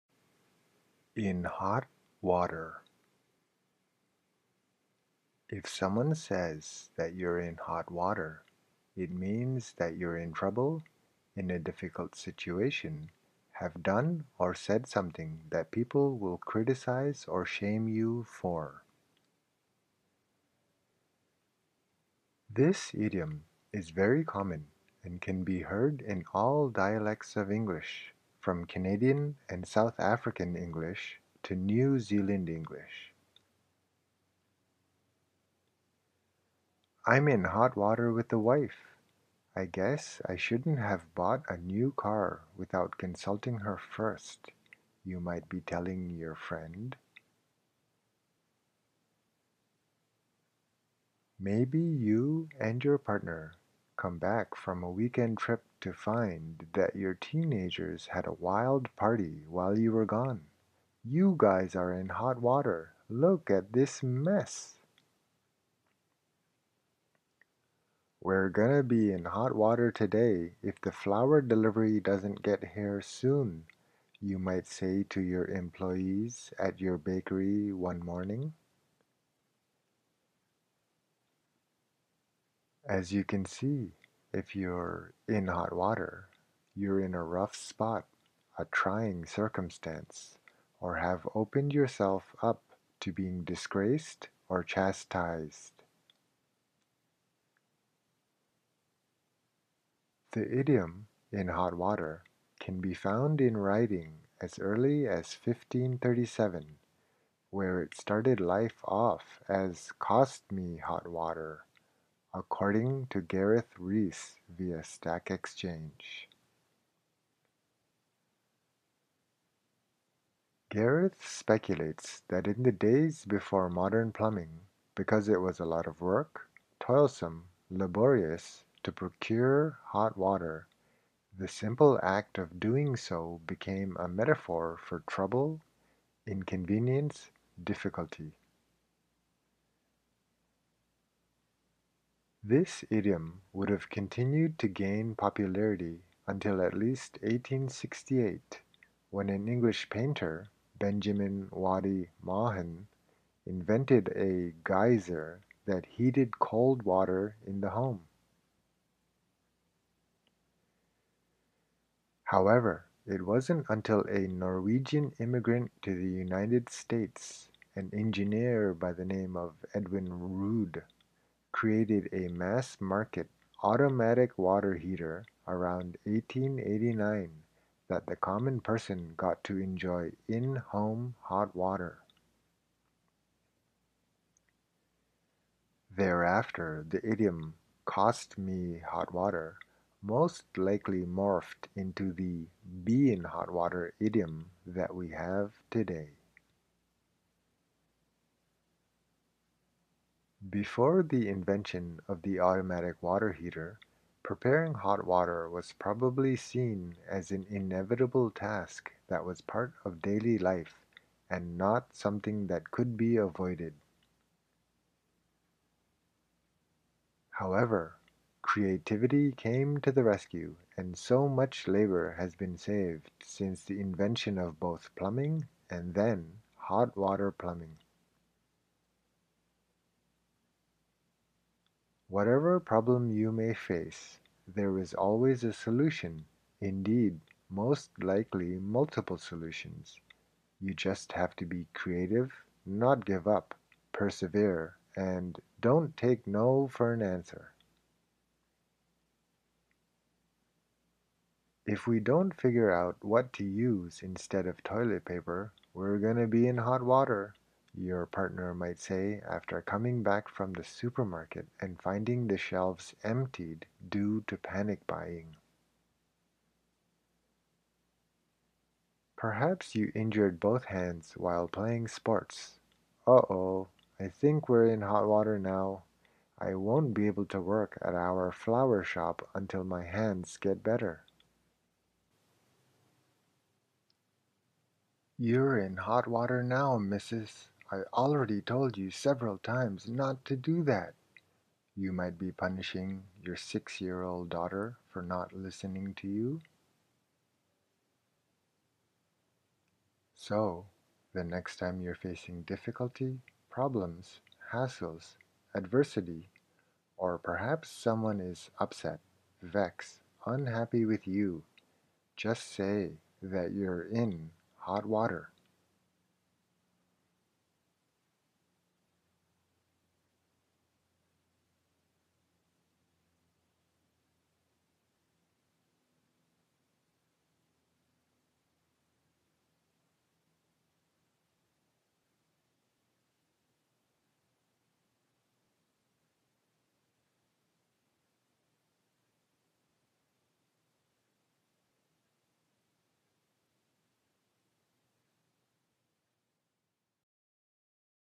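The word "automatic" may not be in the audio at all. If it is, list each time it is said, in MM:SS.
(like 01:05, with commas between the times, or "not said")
02:53, 03:22.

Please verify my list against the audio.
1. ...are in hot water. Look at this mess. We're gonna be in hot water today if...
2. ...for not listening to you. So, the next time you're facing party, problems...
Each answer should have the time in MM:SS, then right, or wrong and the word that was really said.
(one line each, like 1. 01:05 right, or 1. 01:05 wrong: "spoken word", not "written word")
1. 01:01 right
2. 04:54 wrong: "difficulty", not "party".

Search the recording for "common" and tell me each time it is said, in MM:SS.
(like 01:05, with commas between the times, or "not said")
00:24, 02:58.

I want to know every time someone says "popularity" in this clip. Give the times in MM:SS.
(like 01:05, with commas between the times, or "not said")
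02:25.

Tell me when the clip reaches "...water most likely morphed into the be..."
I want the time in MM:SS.
03:09.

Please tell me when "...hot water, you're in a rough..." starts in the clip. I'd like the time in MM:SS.
01:25.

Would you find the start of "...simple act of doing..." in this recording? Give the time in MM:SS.
02:11.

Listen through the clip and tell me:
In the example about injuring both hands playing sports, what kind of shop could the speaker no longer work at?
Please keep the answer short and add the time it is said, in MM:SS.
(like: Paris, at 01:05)
flower shop, at 04:38.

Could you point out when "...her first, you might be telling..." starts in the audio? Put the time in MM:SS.
00:43.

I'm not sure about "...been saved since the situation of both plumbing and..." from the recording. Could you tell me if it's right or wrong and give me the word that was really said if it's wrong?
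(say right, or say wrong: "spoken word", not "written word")
wrong: "invention", not "situation".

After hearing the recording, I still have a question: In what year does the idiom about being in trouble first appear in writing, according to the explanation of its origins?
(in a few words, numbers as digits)
1537.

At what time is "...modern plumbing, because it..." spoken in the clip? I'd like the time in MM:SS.
02:03.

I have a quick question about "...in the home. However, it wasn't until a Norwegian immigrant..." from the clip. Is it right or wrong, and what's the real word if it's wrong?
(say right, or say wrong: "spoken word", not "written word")
right.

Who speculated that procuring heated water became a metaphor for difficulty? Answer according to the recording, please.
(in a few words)
Gareth Rees.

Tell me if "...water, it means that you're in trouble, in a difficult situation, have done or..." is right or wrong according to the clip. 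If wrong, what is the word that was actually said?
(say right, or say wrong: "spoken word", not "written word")
right.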